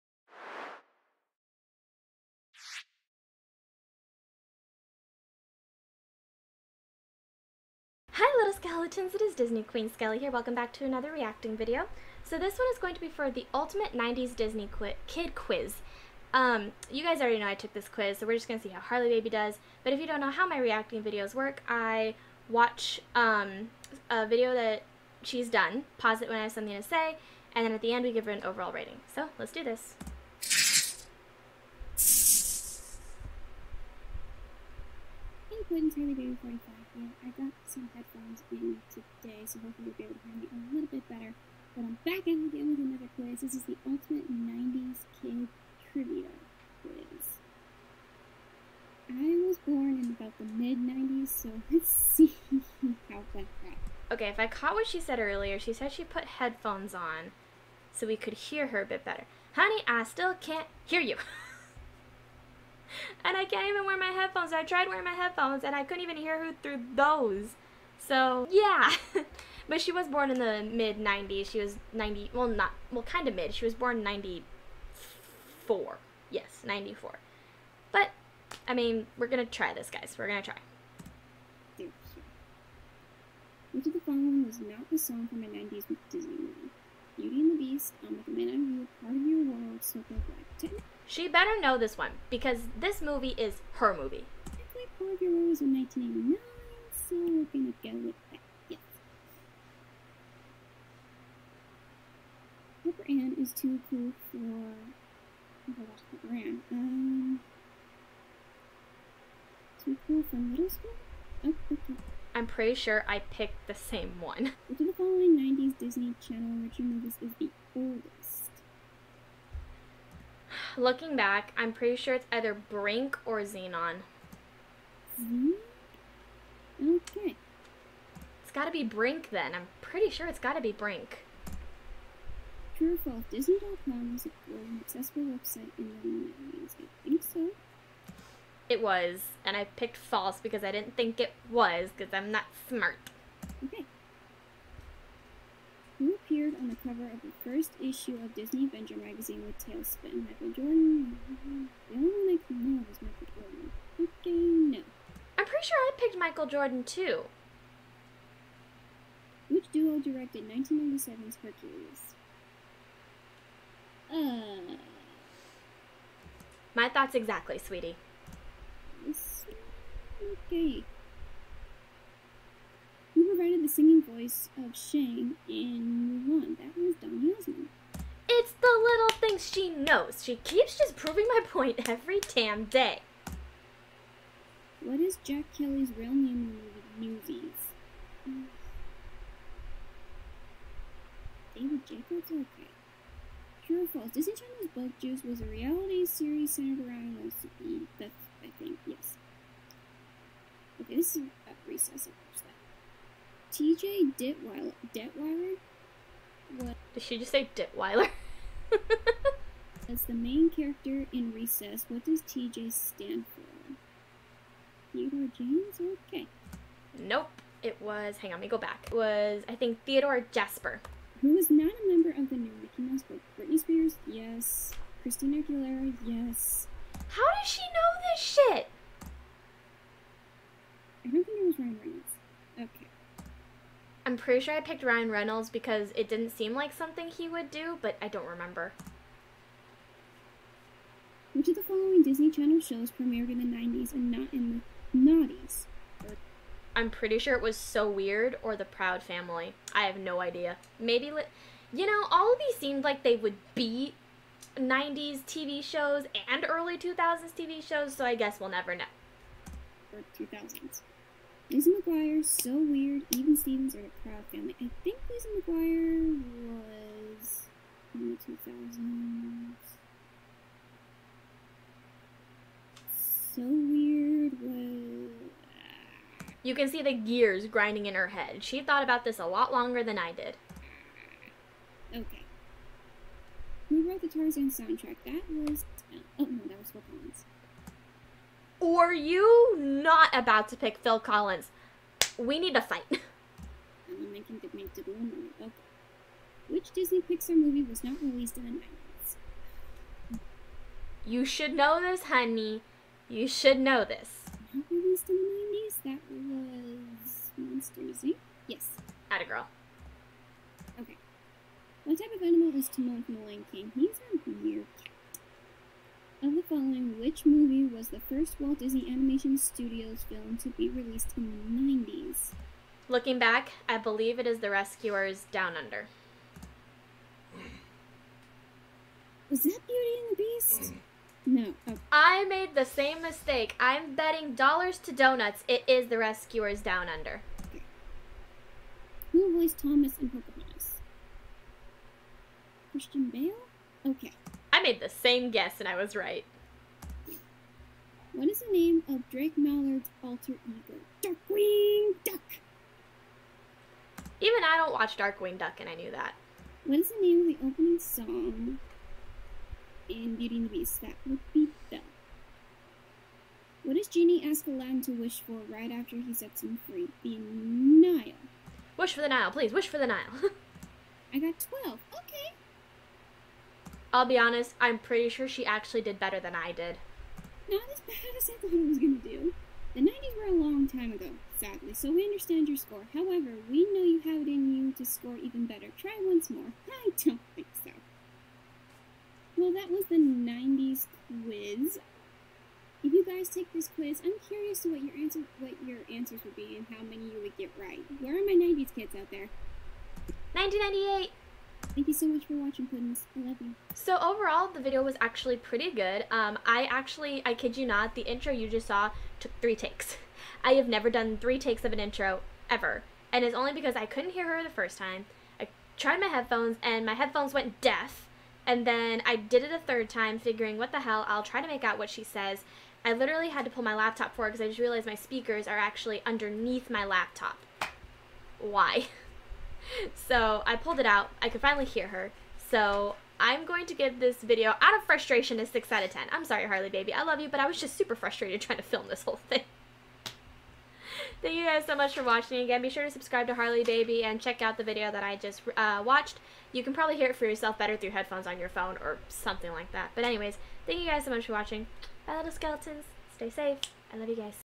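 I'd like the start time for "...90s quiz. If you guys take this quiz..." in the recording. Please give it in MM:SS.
06:29.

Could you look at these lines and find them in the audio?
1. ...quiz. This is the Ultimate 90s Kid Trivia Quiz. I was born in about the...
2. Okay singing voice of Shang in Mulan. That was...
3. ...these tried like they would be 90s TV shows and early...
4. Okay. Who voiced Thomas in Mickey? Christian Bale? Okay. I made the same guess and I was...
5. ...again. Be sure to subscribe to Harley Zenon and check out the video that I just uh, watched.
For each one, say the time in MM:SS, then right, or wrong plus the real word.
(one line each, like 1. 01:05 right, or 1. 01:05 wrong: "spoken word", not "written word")
1. 00:43 right
2. 02:50 right
3. 04:12 wrong: "seemed", not "tried"
4. 05:37 wrong: "Pocahontas", not "Mickey"
5. 07:22 wrong: "Baby", not "Zenon".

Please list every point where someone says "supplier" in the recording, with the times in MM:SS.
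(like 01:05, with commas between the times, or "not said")
not said.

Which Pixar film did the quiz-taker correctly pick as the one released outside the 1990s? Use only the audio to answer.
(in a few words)
Monsters, Inc.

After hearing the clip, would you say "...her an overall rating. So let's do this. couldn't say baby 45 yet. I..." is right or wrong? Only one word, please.
right.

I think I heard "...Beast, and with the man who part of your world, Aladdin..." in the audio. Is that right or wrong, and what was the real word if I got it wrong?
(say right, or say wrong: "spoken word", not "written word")
wrong: "Circle", not "Aladdin".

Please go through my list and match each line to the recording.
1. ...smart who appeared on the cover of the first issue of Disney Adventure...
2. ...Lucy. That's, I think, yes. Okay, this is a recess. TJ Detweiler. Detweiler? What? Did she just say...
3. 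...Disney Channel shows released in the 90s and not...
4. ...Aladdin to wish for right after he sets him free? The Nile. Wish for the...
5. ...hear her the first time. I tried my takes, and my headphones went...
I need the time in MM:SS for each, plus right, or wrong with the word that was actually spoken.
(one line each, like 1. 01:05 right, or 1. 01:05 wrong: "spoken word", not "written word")
1. 02:22 right
2. 03:17 right
3. 04:02 wrong: "premiered", not "released"
4. 06:04 right
5. 06:54 wrong: "headphones", not "takes".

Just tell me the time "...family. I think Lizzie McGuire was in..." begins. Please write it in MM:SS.
04:24.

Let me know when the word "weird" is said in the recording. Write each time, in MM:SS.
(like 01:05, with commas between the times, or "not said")
04:07, 04:22, 04:33, 05:14.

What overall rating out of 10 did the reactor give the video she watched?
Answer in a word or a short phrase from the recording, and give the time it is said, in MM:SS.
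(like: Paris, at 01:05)
6, at 07:15.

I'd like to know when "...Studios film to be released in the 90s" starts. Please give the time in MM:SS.
05:19.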